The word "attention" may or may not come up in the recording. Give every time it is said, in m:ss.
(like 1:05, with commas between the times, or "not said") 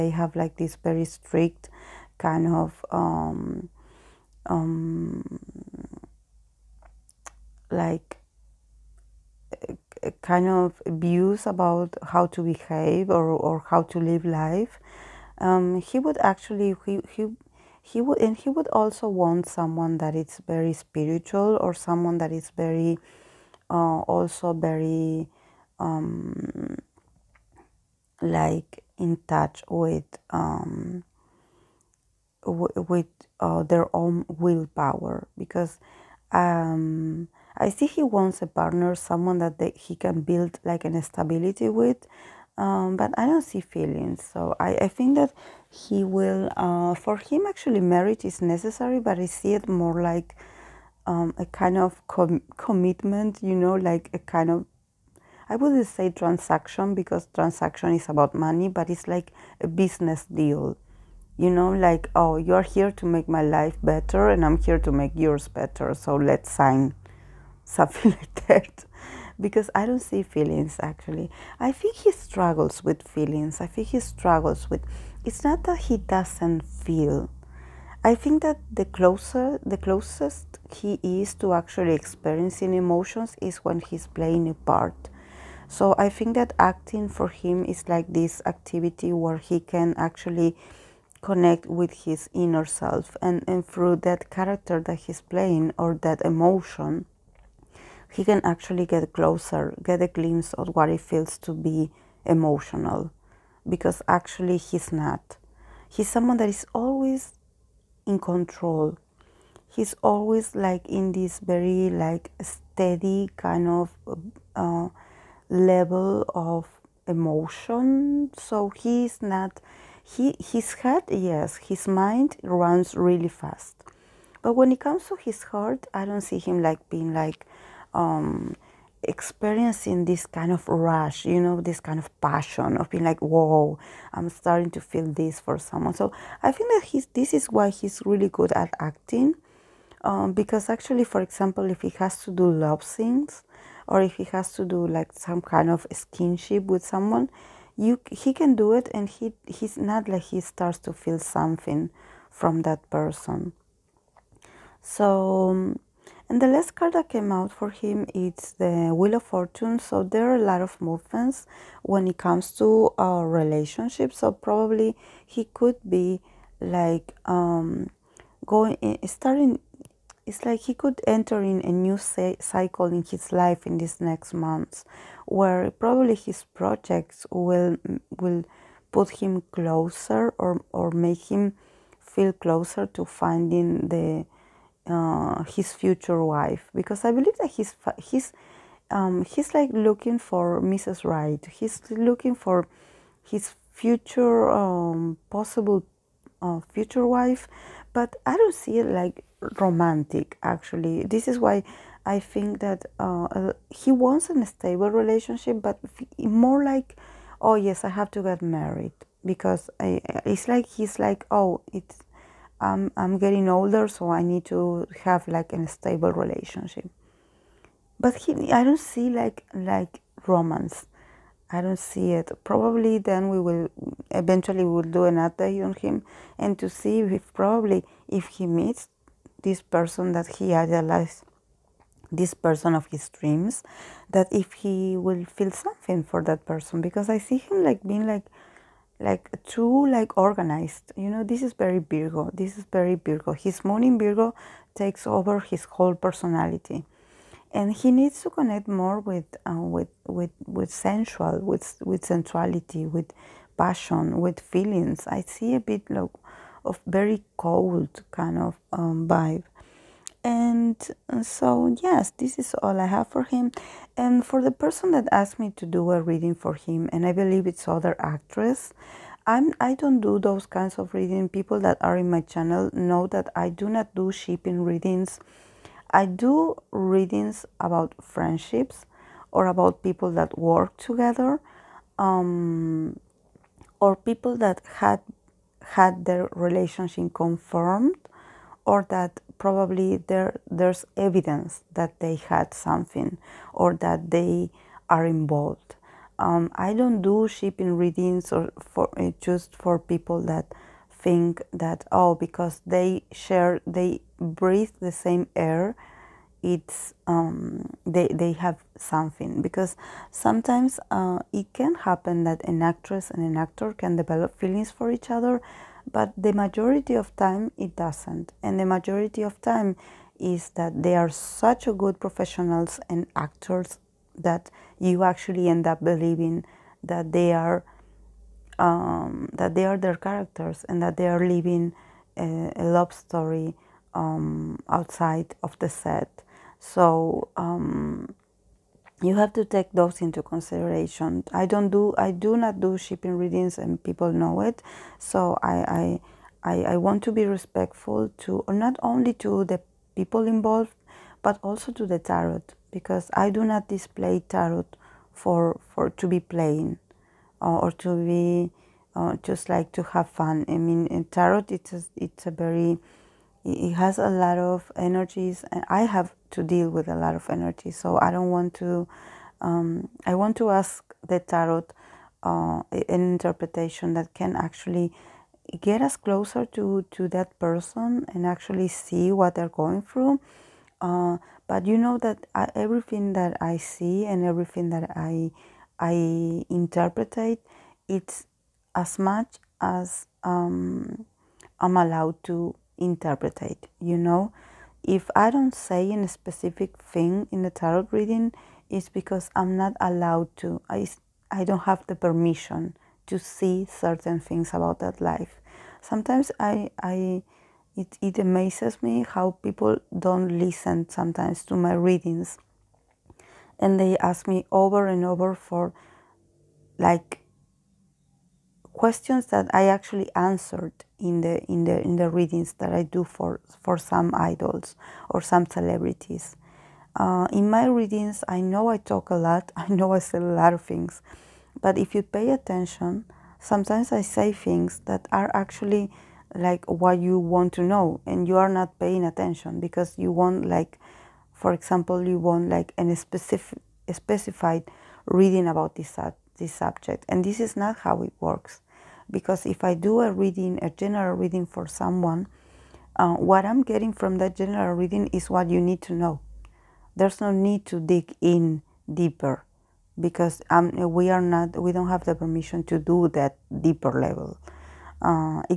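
7:12, 7:19.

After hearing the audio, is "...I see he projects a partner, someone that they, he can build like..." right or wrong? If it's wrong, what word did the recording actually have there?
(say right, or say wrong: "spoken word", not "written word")
wrong: "wants", not "projects".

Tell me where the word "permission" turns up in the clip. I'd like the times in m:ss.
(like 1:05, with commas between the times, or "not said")
6:41, 7:42.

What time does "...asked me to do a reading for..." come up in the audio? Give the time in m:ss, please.
4:25.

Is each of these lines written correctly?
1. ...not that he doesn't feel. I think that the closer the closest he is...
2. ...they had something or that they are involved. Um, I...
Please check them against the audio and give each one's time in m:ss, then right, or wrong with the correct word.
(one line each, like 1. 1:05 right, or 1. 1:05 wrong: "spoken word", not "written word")
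1. 1:15 right
2. 4:51 right.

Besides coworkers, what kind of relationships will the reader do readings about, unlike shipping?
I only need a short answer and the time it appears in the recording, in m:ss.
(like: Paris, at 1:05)
Friendships, at 4:38.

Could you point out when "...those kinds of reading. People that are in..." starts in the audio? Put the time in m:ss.
4:30.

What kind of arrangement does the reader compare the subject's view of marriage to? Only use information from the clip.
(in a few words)
A business deal.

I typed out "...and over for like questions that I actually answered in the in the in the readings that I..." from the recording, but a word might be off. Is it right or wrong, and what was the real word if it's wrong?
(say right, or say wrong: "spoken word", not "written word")
right.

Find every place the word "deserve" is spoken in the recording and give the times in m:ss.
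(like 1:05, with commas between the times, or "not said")
not said.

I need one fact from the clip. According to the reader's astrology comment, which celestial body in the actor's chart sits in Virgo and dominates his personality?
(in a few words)
Moon.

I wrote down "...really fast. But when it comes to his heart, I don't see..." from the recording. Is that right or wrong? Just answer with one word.
right.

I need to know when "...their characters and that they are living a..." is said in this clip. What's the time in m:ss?
5:29.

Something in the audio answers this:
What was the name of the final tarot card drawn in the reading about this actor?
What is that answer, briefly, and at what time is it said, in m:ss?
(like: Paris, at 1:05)
Wheel of Fortune, at 2:38.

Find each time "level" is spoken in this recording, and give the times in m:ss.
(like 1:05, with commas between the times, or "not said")
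1:55, 7:44.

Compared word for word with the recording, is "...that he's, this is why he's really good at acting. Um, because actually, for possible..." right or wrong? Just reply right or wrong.
wrong.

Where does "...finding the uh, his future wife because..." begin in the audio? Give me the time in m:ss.
3:03.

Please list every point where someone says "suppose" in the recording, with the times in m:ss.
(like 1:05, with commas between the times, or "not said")
not said.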